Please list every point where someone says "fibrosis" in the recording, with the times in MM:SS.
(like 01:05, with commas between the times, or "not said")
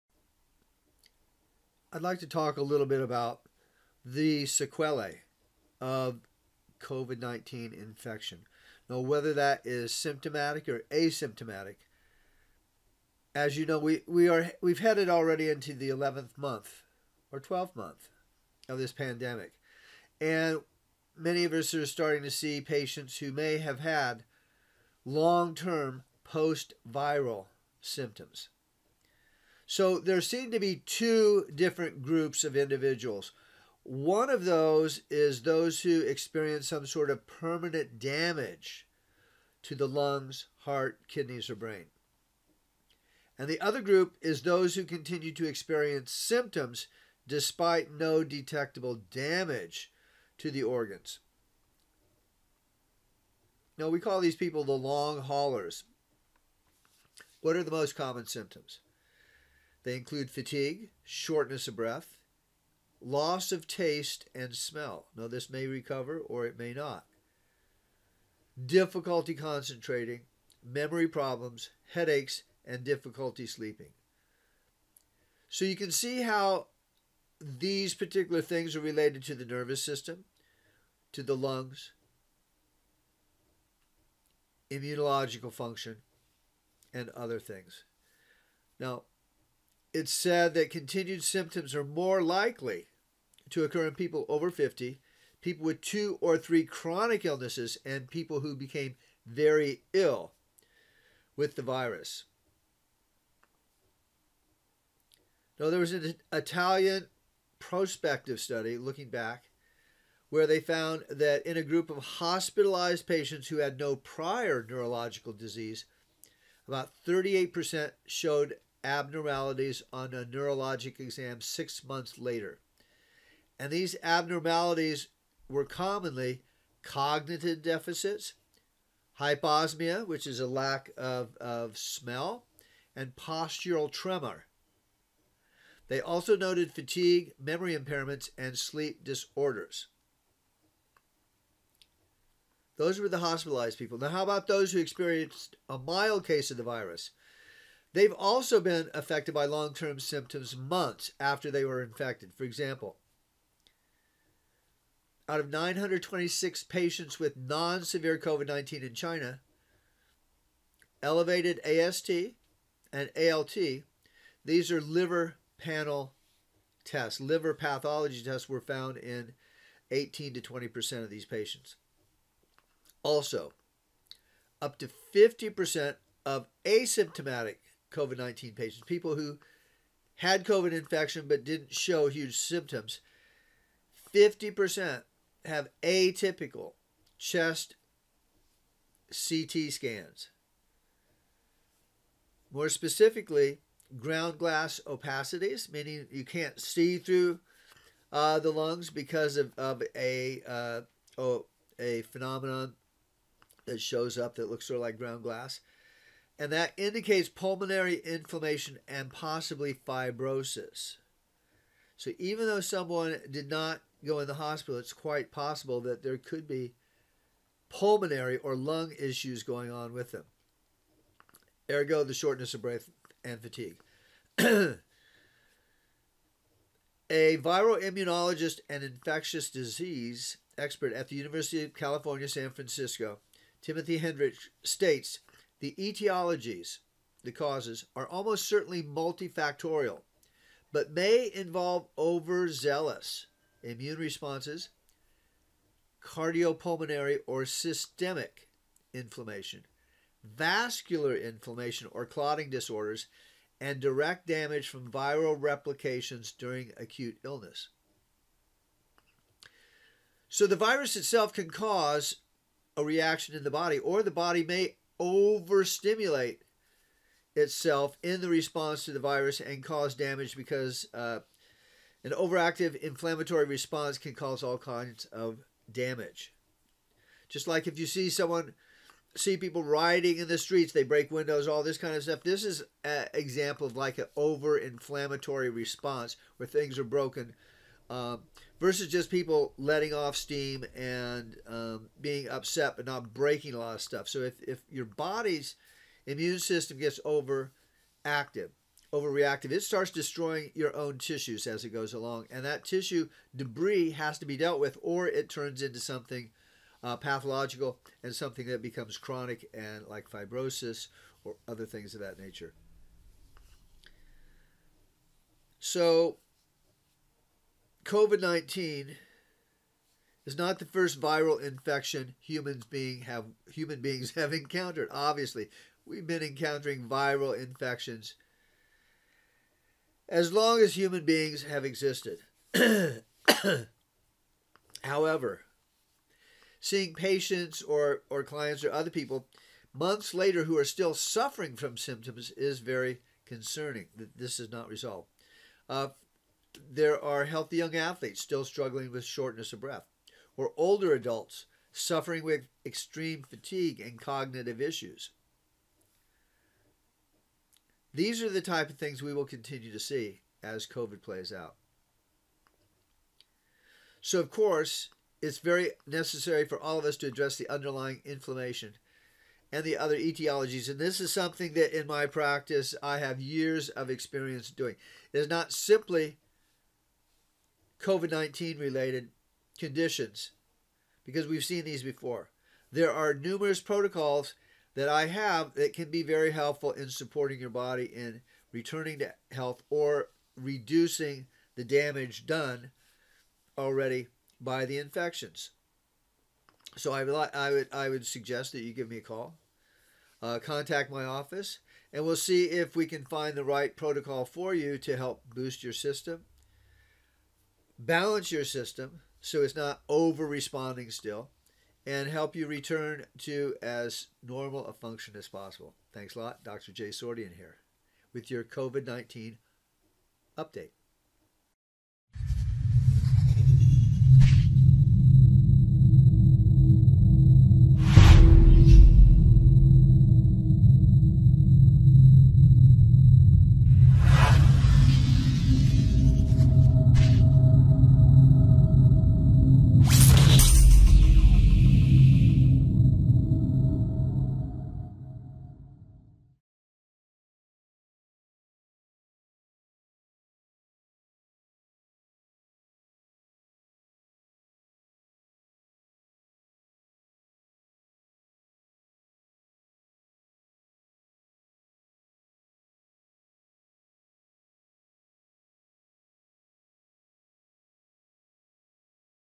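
03:29, 05:10.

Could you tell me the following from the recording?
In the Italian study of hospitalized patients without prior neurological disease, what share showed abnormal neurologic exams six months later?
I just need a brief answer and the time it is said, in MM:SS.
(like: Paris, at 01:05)
38%, at 01:57.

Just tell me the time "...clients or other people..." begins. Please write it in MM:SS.
05:38.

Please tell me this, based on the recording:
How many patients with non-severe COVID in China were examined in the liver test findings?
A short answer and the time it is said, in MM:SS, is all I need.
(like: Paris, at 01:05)
926, at 02:35.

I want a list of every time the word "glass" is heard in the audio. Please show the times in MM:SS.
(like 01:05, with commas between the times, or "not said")
03:14, 03:25.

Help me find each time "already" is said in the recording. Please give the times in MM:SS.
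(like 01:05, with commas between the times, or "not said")
00:15, 06:33.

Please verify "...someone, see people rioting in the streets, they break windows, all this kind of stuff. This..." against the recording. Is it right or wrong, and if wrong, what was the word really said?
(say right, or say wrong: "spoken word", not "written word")
right.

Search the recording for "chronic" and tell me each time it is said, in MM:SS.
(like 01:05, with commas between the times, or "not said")
01:36, 05:08.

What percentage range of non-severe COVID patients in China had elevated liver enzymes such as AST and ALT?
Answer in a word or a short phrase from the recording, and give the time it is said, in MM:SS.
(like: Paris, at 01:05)
18 to 20%, at 02:49.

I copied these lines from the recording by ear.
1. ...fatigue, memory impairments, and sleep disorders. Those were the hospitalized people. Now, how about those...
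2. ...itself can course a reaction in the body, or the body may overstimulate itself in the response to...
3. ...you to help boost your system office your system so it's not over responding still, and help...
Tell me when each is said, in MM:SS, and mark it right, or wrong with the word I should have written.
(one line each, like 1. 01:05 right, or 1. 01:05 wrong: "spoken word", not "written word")
1. 02:16 right
2. 04:20 wrong: "cause", not "course"
3. 06:44 wrong: "balance", not "office".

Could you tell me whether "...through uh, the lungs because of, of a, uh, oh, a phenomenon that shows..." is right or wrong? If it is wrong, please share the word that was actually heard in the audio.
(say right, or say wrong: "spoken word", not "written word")
right.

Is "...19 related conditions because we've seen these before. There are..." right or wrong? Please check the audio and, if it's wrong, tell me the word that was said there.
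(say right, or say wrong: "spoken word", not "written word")
right.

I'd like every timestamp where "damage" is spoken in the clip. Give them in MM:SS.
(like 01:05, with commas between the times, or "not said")
00:37, 00:49, 04:14, 04:29, 04:35, 06:31.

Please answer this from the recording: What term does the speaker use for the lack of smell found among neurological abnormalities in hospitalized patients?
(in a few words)
hyposmia.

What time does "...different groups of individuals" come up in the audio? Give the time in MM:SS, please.
00:31.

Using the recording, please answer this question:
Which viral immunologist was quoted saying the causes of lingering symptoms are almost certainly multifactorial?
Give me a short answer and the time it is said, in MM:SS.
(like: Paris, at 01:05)
Timothy Hendrich, at 03:53.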